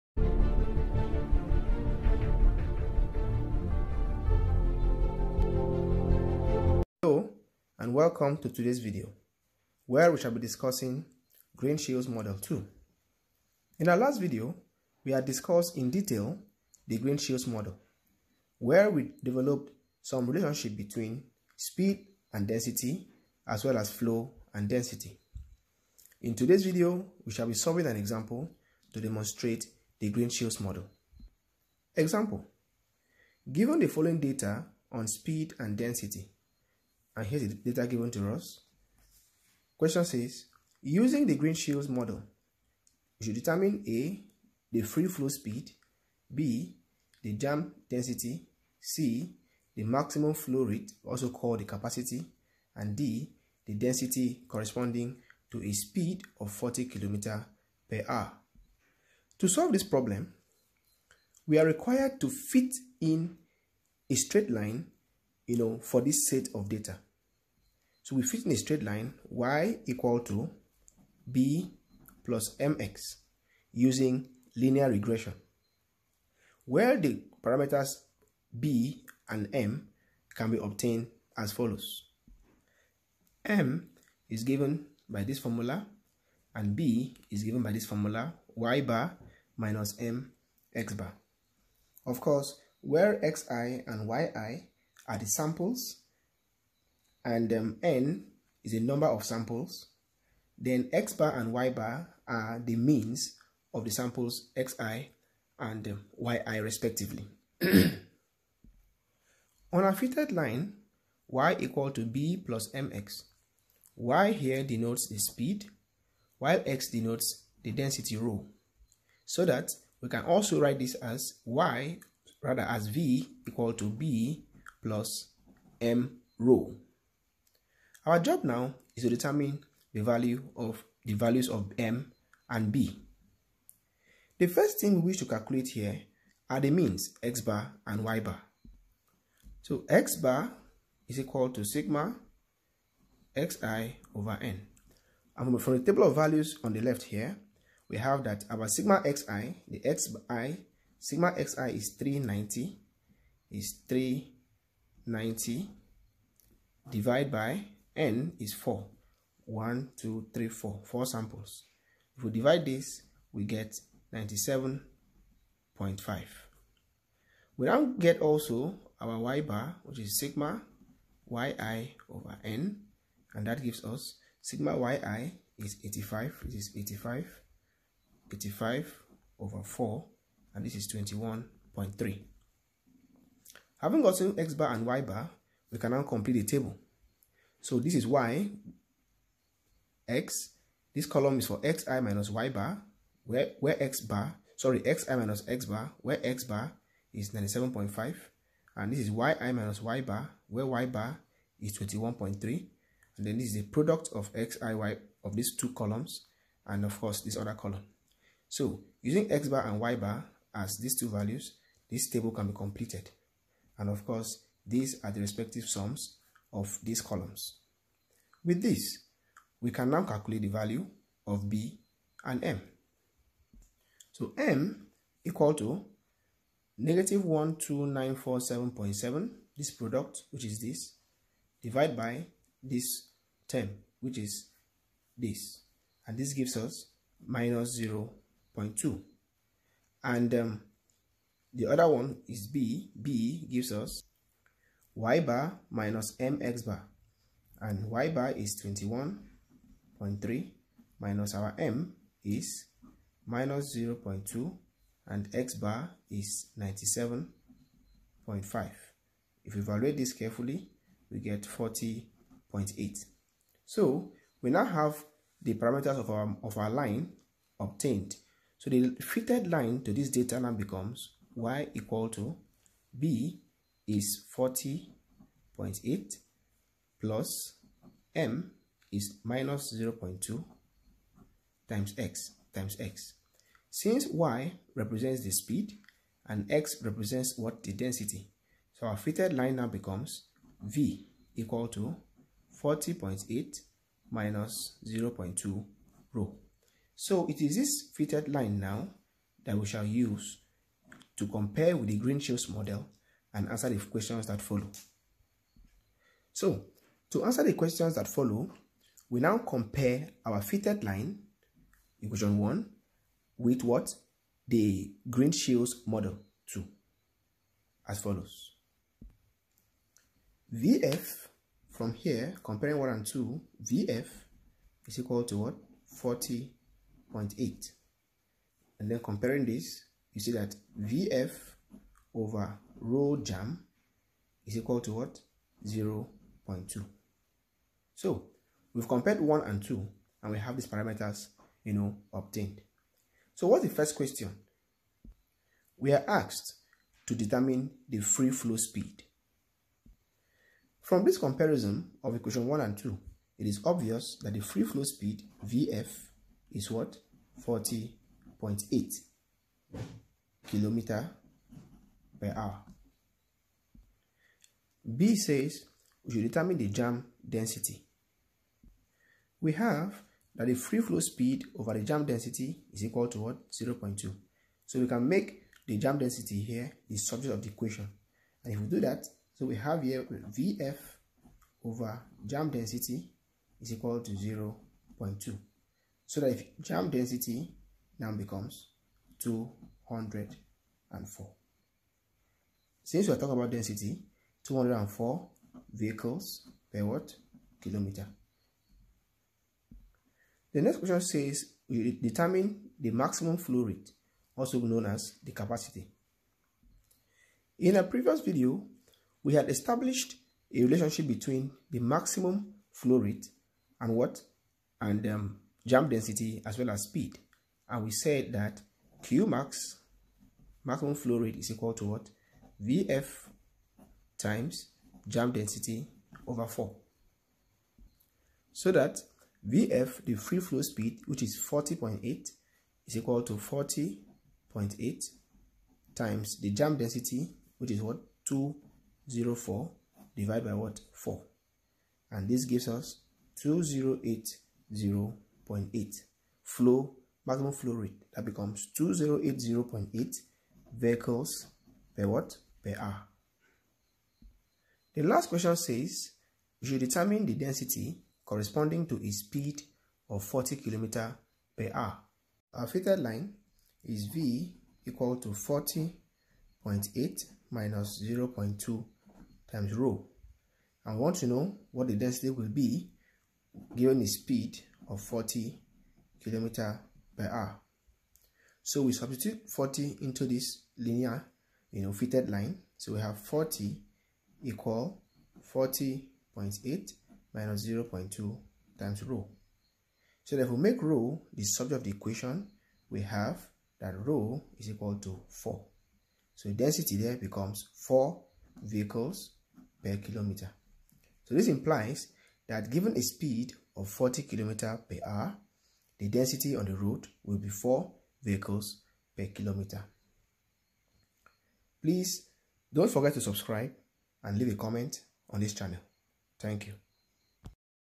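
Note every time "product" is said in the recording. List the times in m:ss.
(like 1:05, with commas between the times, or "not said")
3:23, 3:49.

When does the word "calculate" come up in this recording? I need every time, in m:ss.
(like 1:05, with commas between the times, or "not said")
2:15, 3:40.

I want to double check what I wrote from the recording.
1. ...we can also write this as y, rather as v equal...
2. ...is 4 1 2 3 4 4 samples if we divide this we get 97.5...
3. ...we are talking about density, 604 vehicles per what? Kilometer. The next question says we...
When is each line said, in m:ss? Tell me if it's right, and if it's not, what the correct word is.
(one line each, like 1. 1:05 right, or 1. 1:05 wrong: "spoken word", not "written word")
1. 2:00 right
2. 2:38 right
3. 6:33 wrong: "204", not "604".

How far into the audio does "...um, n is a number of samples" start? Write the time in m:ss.
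1:37.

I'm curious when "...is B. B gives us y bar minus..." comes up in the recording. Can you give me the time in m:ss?
4:02.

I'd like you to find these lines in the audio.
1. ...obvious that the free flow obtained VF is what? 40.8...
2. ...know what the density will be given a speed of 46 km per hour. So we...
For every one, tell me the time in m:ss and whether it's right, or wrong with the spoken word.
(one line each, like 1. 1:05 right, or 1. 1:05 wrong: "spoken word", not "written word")
1. 5:53 wrong: "speed", not "obtained"
2. 7:51 wrong: "40", not "46".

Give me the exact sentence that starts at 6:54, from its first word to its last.
And um, jam density as well as speed.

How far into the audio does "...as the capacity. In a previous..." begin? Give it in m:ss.
6:44.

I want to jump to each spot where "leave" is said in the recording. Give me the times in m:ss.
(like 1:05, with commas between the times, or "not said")
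8:34.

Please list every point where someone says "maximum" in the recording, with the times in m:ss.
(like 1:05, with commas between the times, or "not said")
0:49, 6:42, 6:51, 7:00, 7:27.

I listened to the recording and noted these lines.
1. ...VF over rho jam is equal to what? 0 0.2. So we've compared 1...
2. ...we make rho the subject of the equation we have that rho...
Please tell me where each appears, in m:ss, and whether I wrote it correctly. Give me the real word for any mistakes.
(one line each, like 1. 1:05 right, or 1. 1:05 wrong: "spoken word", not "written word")
1. 5:30 right
2. 8:10 right.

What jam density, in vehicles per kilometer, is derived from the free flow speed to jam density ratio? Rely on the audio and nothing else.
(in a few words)
204.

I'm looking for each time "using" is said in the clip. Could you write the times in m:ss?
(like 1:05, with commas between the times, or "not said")
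0:40, 1:13, 3:29.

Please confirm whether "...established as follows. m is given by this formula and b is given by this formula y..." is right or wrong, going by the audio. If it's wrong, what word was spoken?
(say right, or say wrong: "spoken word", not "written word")
wrong: "obtained", not "established".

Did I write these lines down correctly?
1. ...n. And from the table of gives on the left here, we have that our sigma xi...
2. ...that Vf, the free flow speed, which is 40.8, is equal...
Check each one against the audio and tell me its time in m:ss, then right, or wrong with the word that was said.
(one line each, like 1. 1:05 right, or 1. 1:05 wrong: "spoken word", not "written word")
1. 2:24 wrong: "values", not "gives"
2. 7:08 right.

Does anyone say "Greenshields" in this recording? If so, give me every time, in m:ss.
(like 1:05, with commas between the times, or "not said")
0:11, 0:16, 0:30, 0:41, 5:01, 5:15.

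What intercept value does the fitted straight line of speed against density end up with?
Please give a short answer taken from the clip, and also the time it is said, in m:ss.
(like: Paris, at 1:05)
40.8, at 4:21.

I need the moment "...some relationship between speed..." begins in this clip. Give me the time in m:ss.
0:20.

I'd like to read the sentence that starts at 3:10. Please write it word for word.
This column is for xi minus y bar, where, where x bar, sorry, xi minus x bar, where x bar is 97.5.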